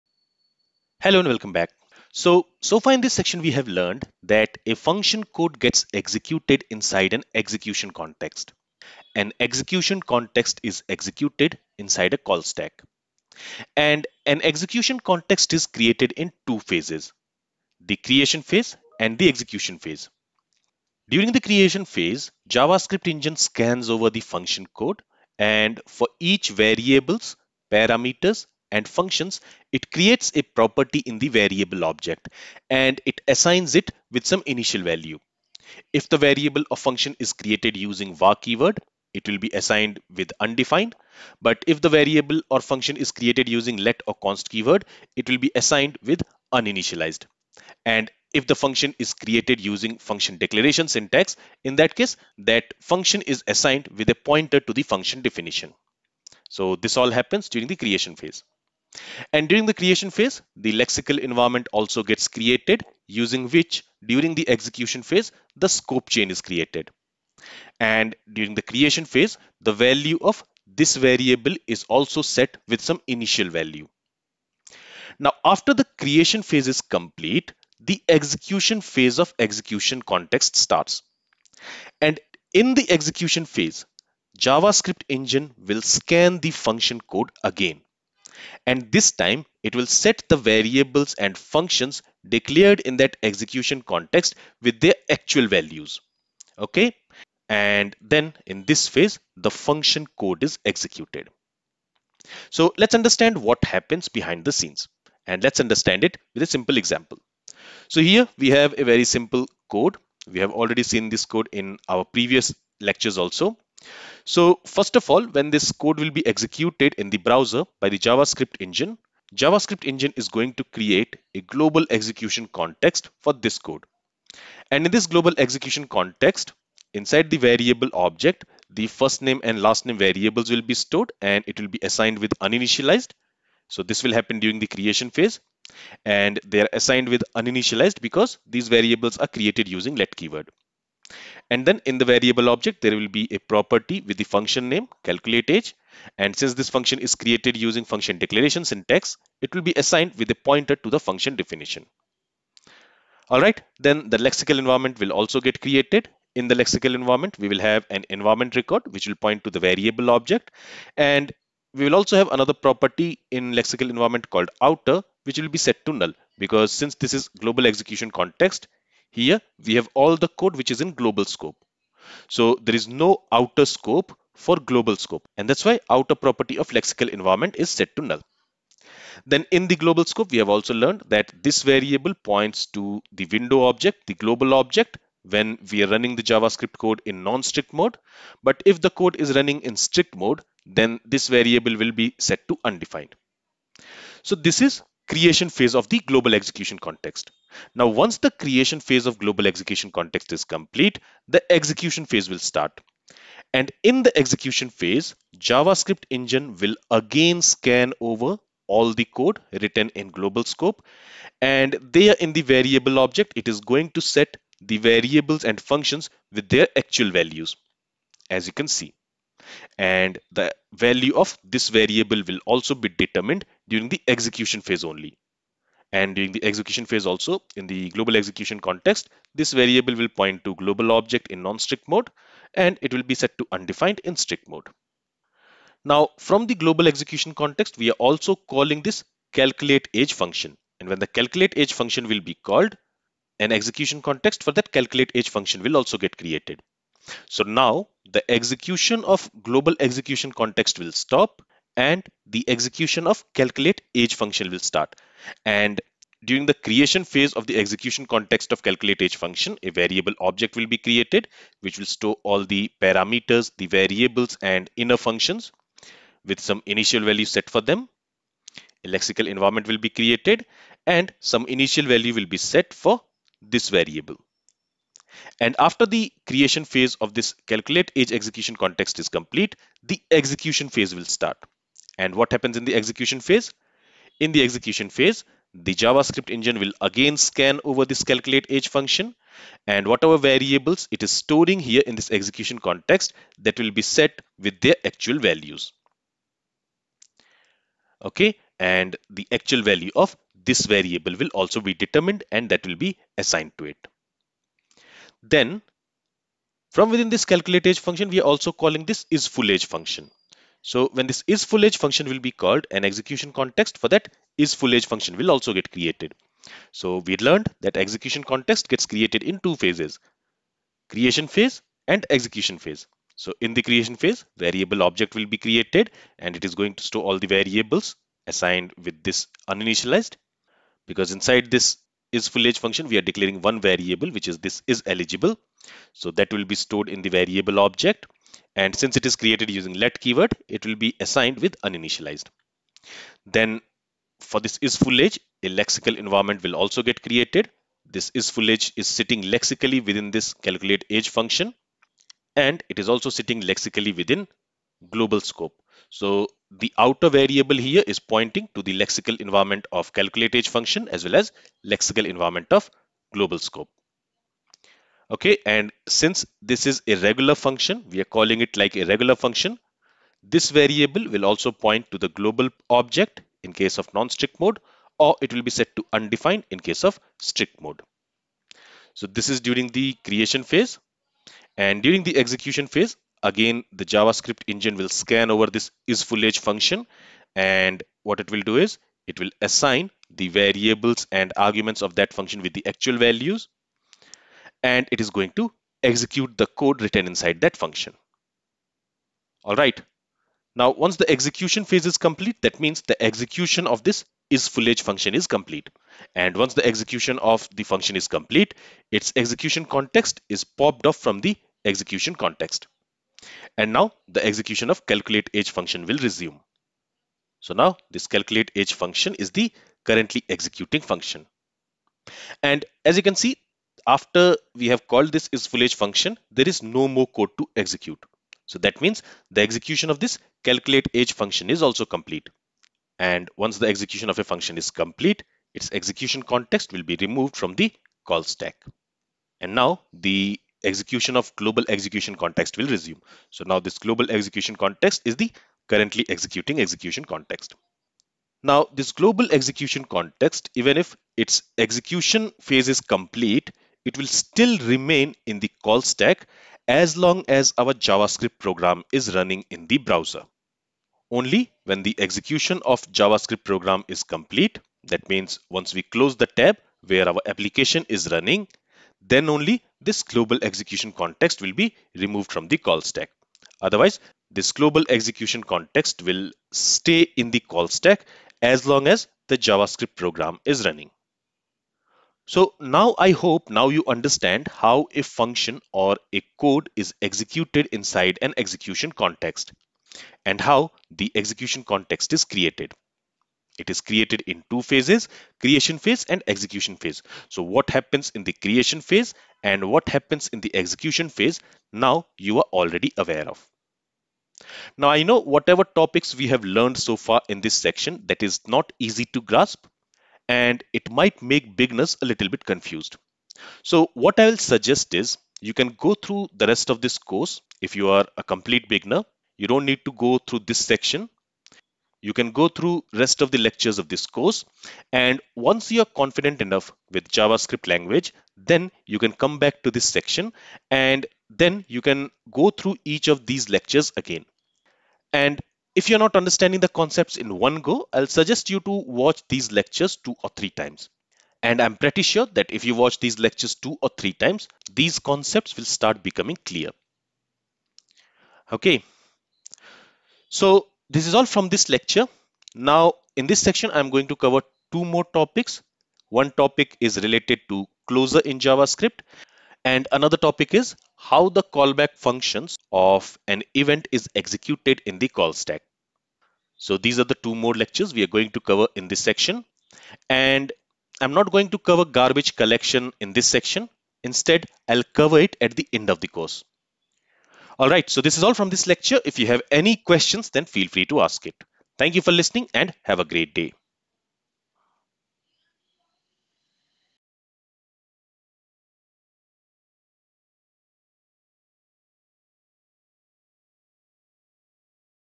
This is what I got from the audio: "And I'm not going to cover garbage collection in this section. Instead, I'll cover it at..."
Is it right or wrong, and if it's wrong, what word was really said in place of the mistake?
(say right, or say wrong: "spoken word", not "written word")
right.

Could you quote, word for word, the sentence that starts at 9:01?
And I'm pretty sure that if you watch these lectures two or three times, these concepts will start becoming clear.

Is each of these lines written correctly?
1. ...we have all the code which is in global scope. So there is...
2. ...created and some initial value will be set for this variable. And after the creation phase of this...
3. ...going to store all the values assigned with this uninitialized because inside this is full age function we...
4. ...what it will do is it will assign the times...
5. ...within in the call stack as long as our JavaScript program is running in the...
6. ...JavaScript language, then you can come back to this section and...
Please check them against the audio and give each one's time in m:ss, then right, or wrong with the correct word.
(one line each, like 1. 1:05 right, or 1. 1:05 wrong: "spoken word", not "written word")
1. 2:49 right
2. 4:29 right
3. 5:26 wrong: "variables", not "values"
4. 6:28 wrong: "variables", not "times"
5. 7:34 wrong: "remain", not "within"
6. 8:47 right.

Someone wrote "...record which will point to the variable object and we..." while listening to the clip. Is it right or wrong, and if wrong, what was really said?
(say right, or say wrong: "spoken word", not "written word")
right.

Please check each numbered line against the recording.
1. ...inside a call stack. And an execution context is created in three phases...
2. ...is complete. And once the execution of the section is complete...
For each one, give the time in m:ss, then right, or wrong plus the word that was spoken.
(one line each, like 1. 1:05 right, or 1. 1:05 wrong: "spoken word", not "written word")
1. 0:11 wrong: "two", not "three"
2. 6:45 wrong: "function", not "section".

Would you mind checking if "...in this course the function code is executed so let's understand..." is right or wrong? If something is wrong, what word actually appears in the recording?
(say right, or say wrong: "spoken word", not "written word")
wrong: "phase", not "course".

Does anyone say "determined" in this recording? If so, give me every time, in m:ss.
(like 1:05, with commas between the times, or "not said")
3:42, 5:01.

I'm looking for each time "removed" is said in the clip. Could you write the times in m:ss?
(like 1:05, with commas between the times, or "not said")
7:17, 7:51.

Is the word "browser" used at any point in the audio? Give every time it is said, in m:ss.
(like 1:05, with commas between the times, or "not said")
1:57, 7:39.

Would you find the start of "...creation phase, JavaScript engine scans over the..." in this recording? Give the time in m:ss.
0:21.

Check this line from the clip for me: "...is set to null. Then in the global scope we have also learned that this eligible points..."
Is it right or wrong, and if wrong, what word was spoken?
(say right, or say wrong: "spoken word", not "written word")
wrong: "variable", not "eligible".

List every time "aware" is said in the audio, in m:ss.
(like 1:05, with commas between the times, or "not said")
8:22.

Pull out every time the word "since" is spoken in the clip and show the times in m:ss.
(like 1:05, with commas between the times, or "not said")
2:26, 2:46, 5:38, 6:05.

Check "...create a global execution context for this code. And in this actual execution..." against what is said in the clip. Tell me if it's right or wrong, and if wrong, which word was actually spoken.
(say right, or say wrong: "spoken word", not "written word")
wrong: "global", not "actual".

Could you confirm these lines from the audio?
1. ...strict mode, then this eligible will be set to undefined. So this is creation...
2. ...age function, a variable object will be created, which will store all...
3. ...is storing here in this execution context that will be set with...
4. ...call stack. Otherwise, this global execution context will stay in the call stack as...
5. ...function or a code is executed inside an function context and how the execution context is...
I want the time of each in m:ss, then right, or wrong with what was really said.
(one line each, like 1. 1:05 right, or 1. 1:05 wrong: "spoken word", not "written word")
1. 3:09 wrong: "variable", not "eligible"
2. 4:19 right
3. 4:51 right
4. 7:52 right
5. 8:05 wrong: "execution", not "function".